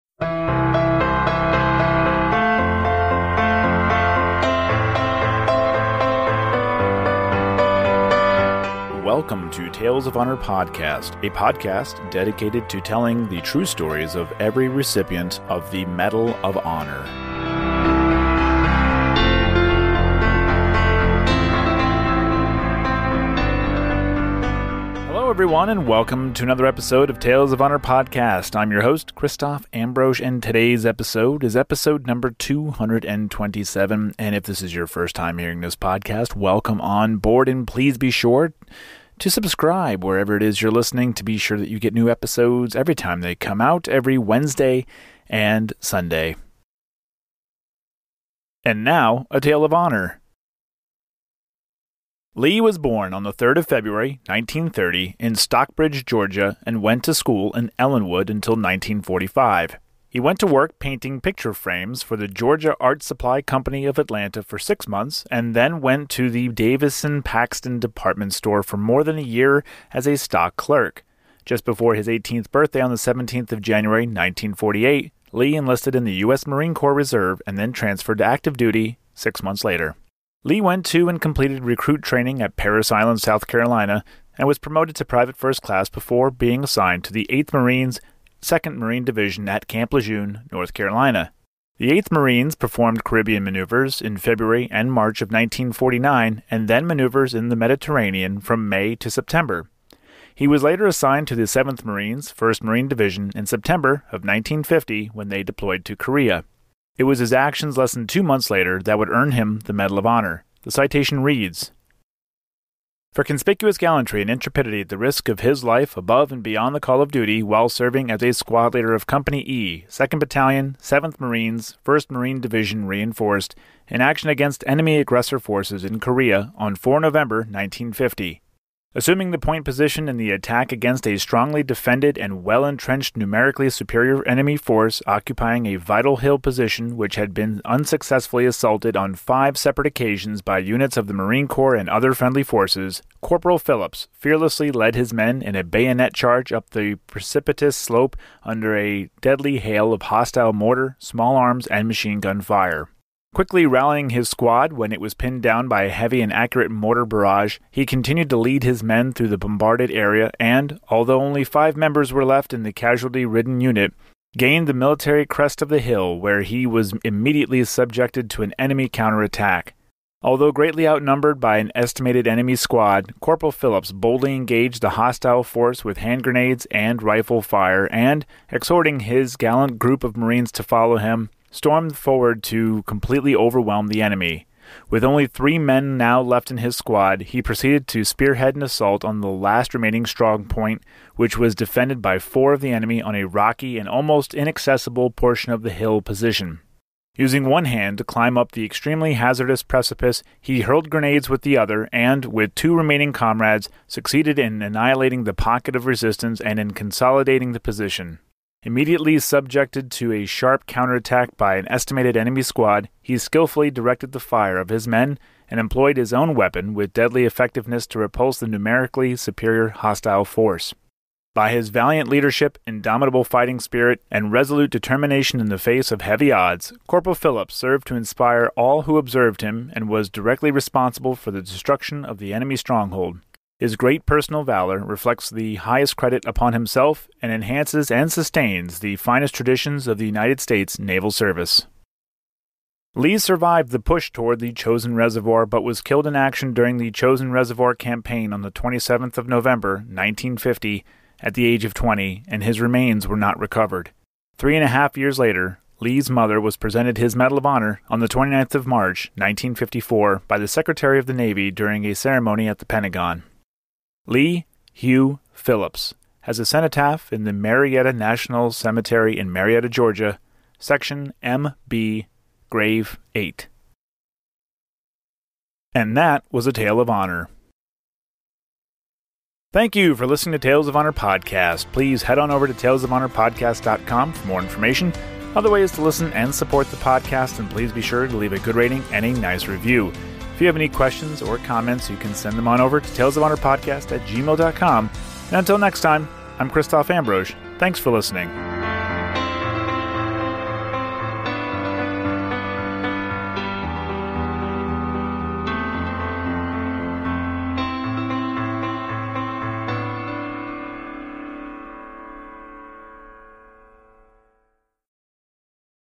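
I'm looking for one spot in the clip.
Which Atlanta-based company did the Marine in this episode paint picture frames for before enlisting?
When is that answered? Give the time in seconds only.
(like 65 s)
62 s.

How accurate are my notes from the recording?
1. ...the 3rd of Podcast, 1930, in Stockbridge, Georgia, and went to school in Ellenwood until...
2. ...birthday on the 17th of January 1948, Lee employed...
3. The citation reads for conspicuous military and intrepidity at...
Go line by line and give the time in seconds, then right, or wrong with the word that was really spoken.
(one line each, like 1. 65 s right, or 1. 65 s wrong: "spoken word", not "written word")
1. 53 s wrong: "February", not "Podcast"
2. 72 s wrong: "enlisted", not "employed"
3. 110 s wrong: "gallantry", not "military".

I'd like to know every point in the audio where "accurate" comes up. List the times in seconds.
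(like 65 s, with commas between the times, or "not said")
156 s.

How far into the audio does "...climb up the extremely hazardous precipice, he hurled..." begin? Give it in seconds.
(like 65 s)
198 s.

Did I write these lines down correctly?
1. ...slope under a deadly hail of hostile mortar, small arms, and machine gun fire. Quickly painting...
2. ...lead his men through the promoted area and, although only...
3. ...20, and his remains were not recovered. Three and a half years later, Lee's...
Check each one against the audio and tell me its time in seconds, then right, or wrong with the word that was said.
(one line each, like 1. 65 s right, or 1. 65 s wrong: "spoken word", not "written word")
1. 147 s wrong: "rallying", not "painting"
2. 158 s wrong: "bombarded", not "promoted"
3. 251 s right.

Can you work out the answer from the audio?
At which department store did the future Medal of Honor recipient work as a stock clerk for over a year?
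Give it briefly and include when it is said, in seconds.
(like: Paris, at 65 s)
Davison Paxton, at 66 s.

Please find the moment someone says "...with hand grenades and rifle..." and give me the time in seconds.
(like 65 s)
175 s.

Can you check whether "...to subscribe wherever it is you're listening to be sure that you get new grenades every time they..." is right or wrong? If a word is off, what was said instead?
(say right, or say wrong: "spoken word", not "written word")
wrong: "episodes", not "grenades".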